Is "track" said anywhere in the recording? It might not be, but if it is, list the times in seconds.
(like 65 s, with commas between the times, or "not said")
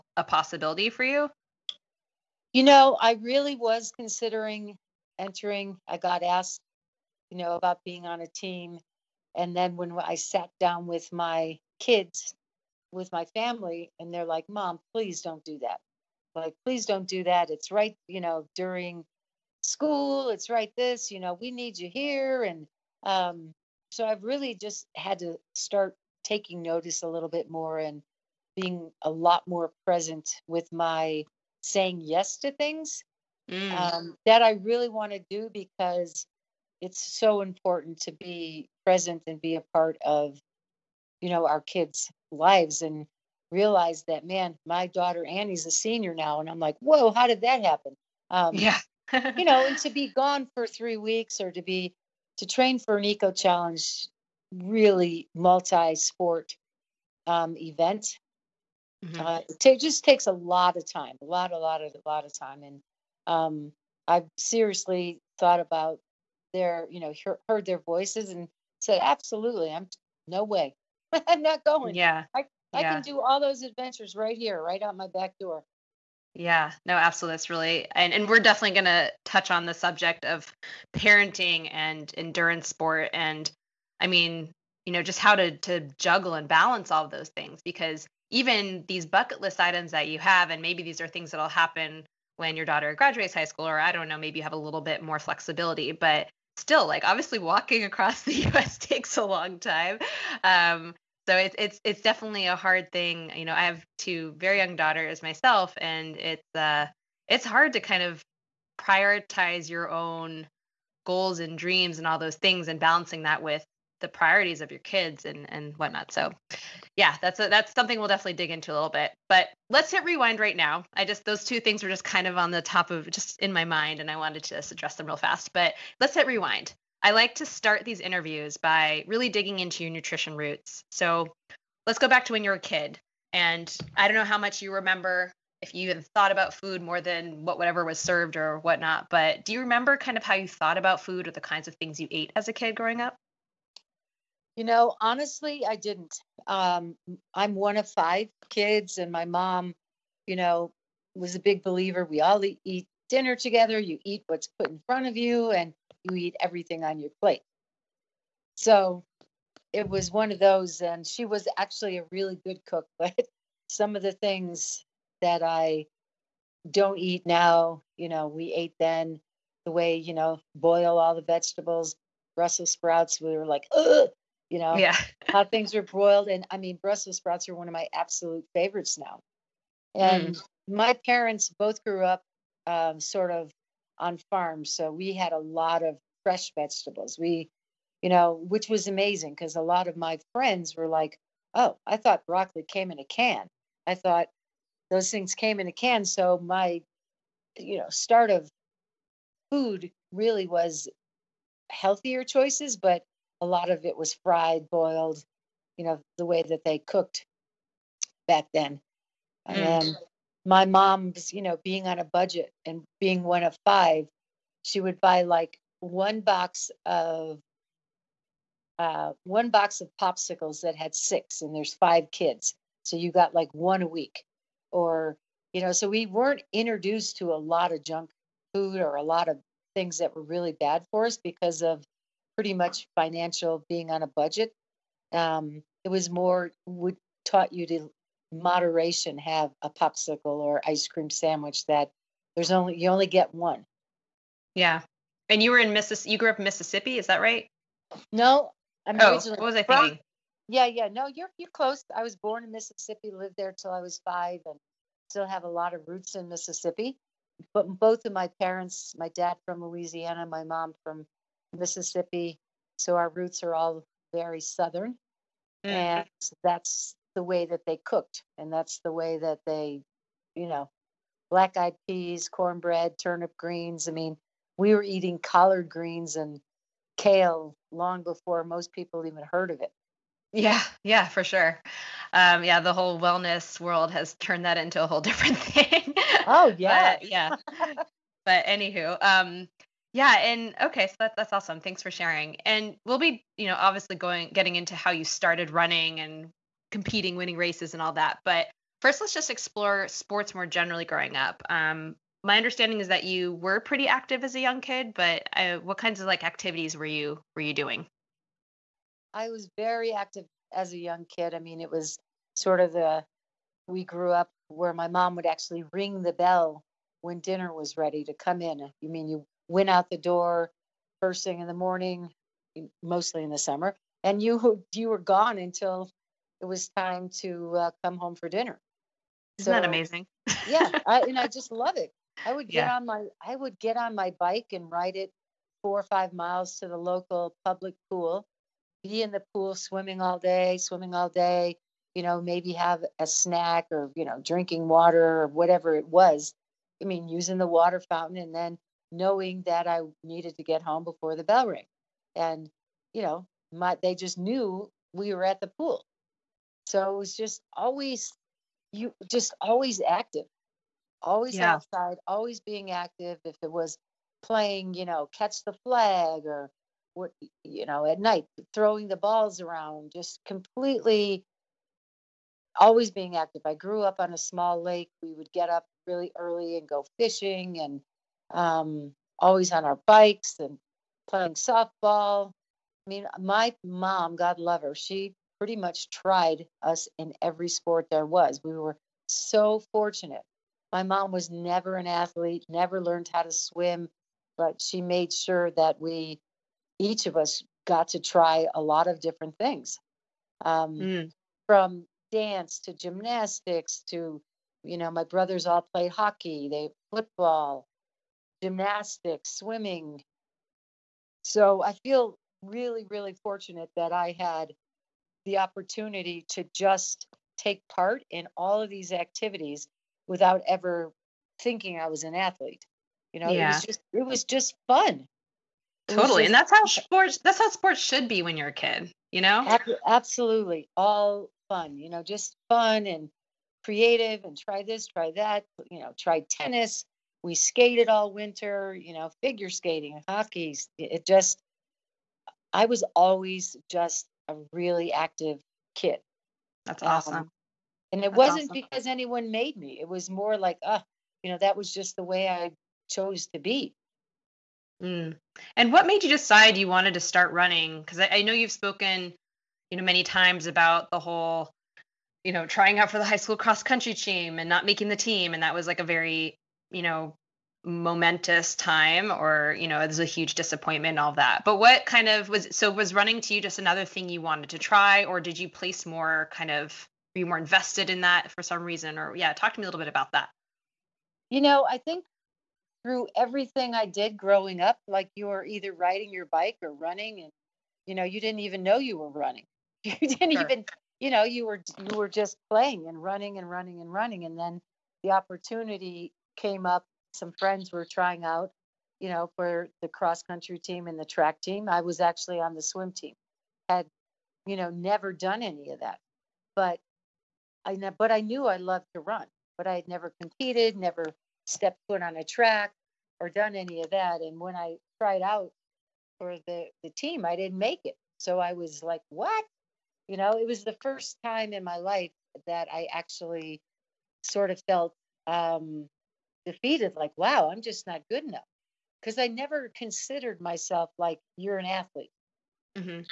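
501 s, 512 s.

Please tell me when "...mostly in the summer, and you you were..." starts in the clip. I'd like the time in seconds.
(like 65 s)
322 s.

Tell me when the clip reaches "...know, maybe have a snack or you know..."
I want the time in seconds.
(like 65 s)
342 s.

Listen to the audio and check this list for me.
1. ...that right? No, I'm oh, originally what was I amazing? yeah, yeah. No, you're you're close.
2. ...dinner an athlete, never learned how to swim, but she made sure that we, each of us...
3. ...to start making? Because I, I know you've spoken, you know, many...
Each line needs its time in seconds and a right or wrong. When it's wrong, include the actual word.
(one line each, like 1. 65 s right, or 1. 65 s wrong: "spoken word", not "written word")
1. 247 s wrong: "thinking", not "amazing"
2. 391 s wrong: "never", not "dinner"
3. 456 s wrong: "running", not "making".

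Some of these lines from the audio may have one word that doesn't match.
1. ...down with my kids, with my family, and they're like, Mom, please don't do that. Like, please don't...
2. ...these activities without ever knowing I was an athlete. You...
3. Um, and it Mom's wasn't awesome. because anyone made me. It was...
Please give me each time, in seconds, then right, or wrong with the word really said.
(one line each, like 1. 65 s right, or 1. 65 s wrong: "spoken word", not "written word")
1. 10 s right
2. 418 s wrong: "thinking", not "knowing"
3. 447 s wrong: "That", not "Mom".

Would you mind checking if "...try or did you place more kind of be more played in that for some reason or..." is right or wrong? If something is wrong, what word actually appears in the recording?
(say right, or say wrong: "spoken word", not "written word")
wrong: "invested", not "played".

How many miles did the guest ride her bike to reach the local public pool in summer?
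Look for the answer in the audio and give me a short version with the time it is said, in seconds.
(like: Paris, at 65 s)
4 or 5 miles, at 335 s.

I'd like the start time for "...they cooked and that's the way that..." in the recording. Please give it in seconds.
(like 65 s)
267 s.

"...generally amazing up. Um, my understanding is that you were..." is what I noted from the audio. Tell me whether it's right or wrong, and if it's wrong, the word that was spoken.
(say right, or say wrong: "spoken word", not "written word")
wrong: "growing", not "amazing".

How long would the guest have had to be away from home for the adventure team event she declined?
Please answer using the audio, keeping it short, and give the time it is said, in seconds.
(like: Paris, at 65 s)
3 weeks, at 50 s.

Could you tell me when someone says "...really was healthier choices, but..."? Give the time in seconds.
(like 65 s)
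200 s.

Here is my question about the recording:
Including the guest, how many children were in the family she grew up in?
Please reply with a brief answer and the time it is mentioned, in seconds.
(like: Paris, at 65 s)
5, at 147 s.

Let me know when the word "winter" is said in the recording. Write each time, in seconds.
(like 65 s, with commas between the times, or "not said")
438 s.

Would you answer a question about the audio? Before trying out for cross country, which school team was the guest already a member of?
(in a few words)
swim team.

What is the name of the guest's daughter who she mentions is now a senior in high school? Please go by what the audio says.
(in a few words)
Annie.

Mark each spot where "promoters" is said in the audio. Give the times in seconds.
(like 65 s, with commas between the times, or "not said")
not said.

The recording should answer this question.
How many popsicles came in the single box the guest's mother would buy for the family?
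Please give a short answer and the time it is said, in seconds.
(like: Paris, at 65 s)
6, at 220 s.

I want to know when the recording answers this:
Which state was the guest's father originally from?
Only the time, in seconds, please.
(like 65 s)
259 s.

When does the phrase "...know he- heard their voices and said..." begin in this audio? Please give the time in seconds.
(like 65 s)
67 s.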